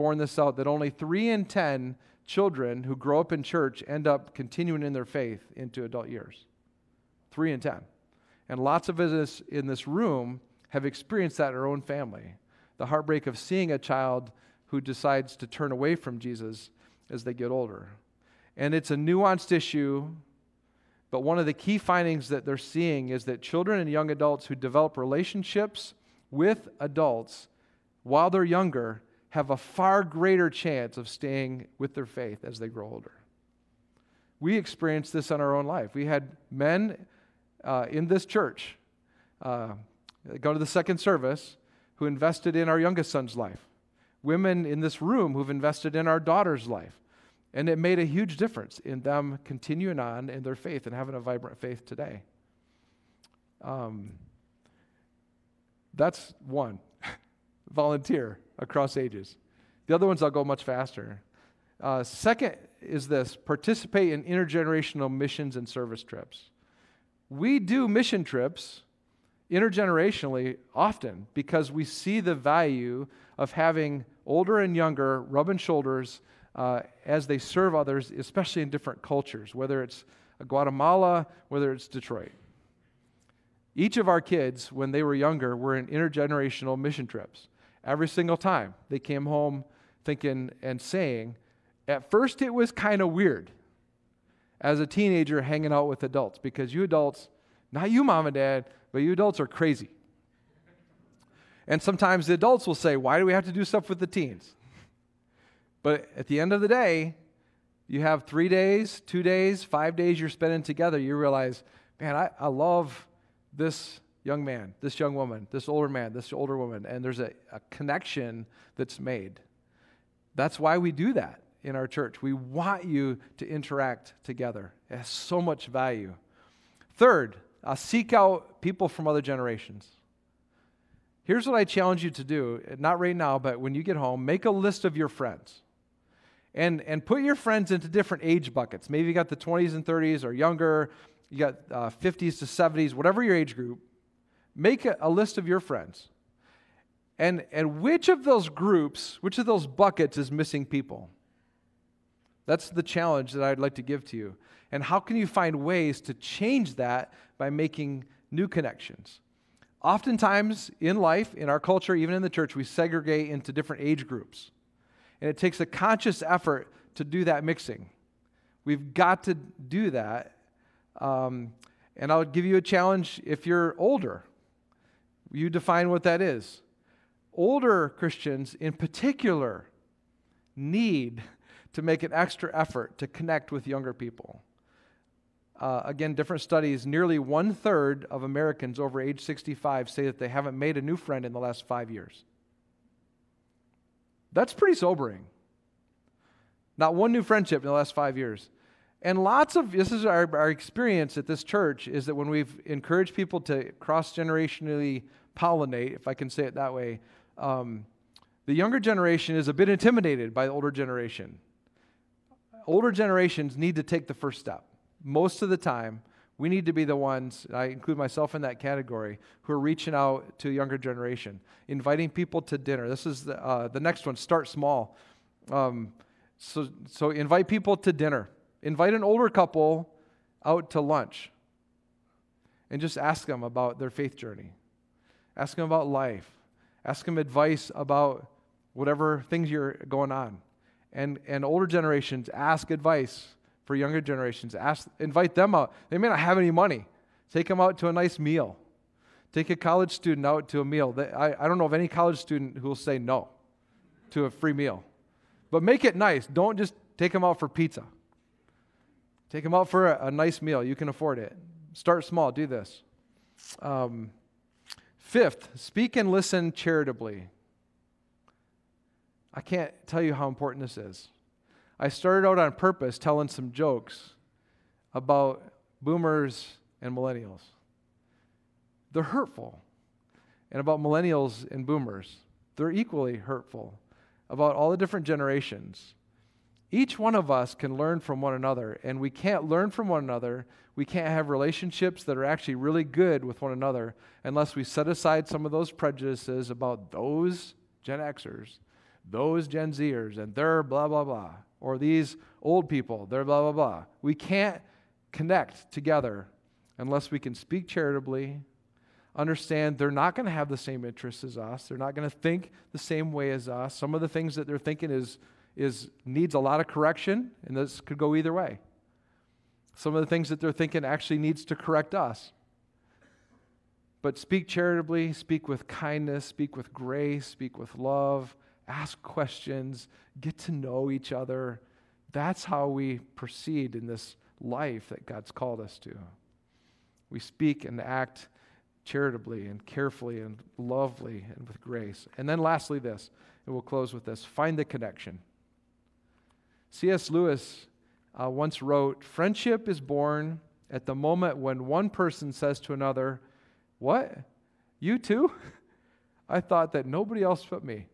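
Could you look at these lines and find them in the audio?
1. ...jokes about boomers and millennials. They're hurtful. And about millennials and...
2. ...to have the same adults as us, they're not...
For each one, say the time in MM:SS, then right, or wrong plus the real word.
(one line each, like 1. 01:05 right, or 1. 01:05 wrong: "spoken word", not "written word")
1. 04:33 right
2. 05:10 wrong: "interests", not "adults".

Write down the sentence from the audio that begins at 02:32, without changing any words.
That's the challenge that I'd like to give to you.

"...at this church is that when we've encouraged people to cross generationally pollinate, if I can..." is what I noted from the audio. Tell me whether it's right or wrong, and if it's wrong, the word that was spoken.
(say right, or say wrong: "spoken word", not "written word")
right.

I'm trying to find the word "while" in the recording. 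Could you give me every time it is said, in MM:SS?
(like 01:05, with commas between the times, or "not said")
00:28.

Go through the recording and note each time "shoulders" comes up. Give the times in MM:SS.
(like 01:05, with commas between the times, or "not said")
01:15.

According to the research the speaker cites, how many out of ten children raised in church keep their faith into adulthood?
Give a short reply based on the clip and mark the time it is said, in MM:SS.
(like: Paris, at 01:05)
3, at 00:00.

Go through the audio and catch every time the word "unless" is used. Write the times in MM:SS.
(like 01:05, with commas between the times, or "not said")
04:54, 05:06.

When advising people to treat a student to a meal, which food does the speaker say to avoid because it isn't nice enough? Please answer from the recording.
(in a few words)
pizza.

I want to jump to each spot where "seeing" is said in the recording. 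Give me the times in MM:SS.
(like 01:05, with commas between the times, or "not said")
00:13, 00:22.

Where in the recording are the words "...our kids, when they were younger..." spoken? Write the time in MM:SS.
01:24.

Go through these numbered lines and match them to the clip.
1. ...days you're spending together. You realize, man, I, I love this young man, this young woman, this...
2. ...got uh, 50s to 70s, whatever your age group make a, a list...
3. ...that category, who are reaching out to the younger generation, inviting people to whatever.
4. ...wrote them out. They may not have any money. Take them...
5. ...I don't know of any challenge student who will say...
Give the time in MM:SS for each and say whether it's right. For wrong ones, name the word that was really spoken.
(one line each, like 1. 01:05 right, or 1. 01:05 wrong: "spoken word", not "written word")
1. 01:49 right
2. 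02:21 right
3. 03:38 wrong: "dinner", not "whatever"
4. 04:04 wrong: "invite", not "wrote"
5. 04:11 wrong: "college", not "challenge".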